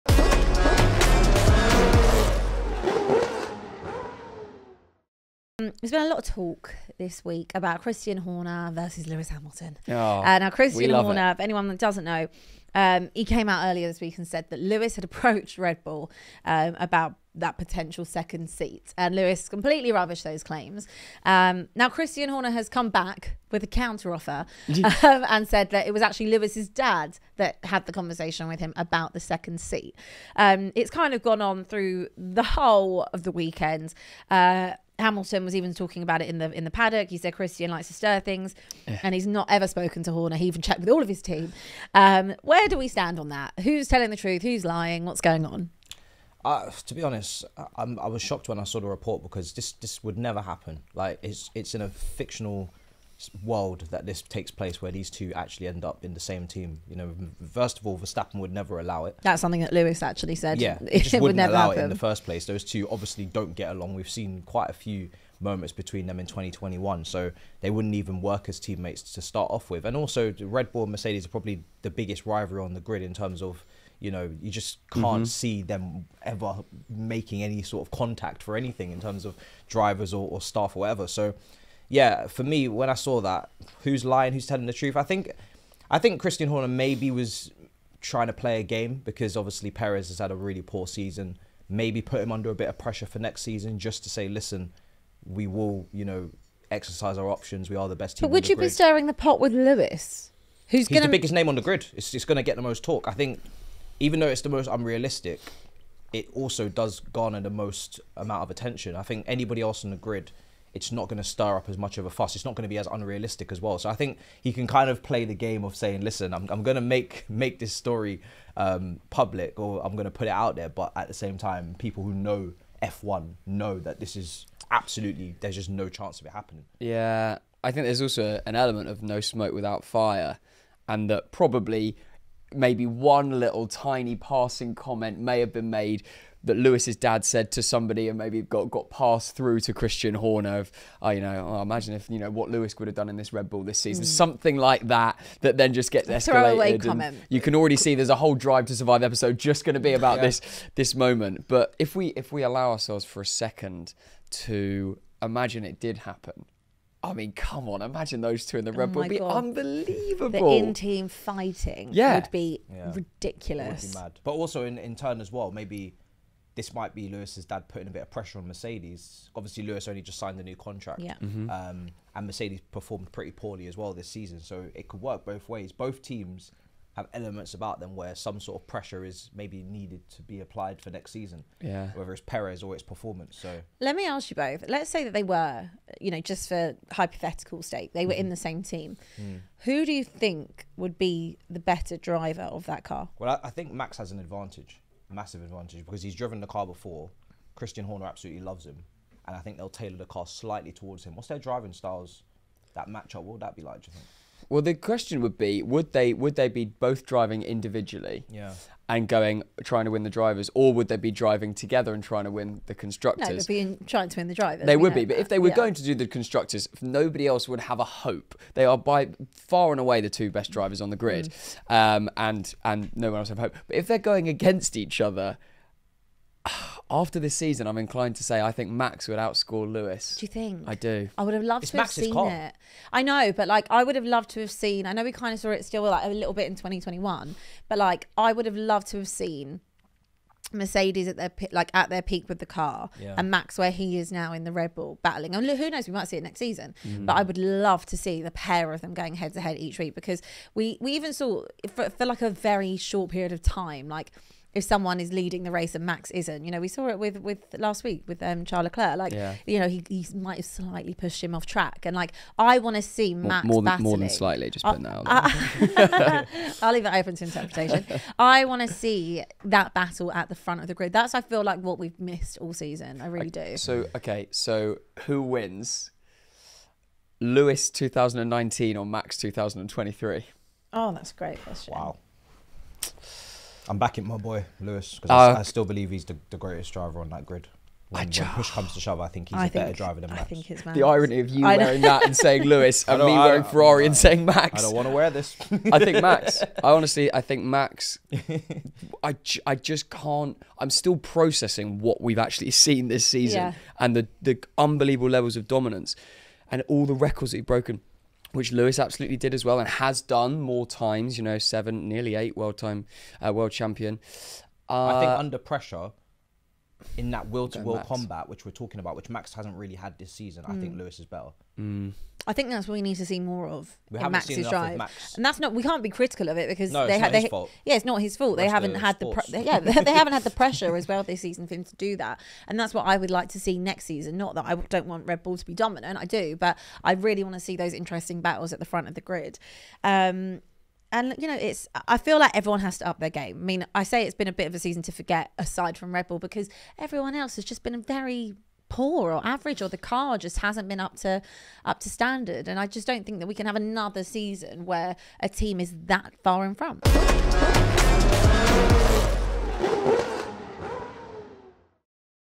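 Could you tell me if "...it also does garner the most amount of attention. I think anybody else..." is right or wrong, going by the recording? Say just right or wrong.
right.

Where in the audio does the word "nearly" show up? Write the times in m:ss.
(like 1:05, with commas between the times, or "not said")
5:11.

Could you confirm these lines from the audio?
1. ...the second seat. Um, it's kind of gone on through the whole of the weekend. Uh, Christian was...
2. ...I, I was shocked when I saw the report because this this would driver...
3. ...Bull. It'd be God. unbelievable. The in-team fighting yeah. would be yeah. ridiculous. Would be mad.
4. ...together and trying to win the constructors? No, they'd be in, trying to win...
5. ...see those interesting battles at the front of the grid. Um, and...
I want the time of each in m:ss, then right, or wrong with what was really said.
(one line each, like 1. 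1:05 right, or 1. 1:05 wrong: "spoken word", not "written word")
1. 0:29 wrong: "Hamilton", not "Christian"
2. 0:47 wrong: "never", not "driver"
3. 2:38 right
4. 3:31 right
5. 5:37 right.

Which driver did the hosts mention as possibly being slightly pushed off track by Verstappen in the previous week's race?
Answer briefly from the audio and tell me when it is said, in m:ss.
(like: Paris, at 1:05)
Charles Leclerc, at 4:18.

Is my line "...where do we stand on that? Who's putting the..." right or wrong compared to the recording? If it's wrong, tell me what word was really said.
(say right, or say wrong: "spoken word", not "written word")
wrong: "telling", not "putting".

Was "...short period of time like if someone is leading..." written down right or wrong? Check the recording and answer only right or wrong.
right.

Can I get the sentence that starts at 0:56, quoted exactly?
You know, first of all, Verstappen would never allow it.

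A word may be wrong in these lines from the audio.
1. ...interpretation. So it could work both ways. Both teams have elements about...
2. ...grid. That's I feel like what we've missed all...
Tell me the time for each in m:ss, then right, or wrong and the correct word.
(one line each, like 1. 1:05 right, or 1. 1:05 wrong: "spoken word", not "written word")
1. 2:54 wrong: "season", not "interpretation"
2. 4:30 right.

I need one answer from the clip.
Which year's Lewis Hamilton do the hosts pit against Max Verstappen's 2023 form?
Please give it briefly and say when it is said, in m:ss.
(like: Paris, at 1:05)
2019, at 4:37.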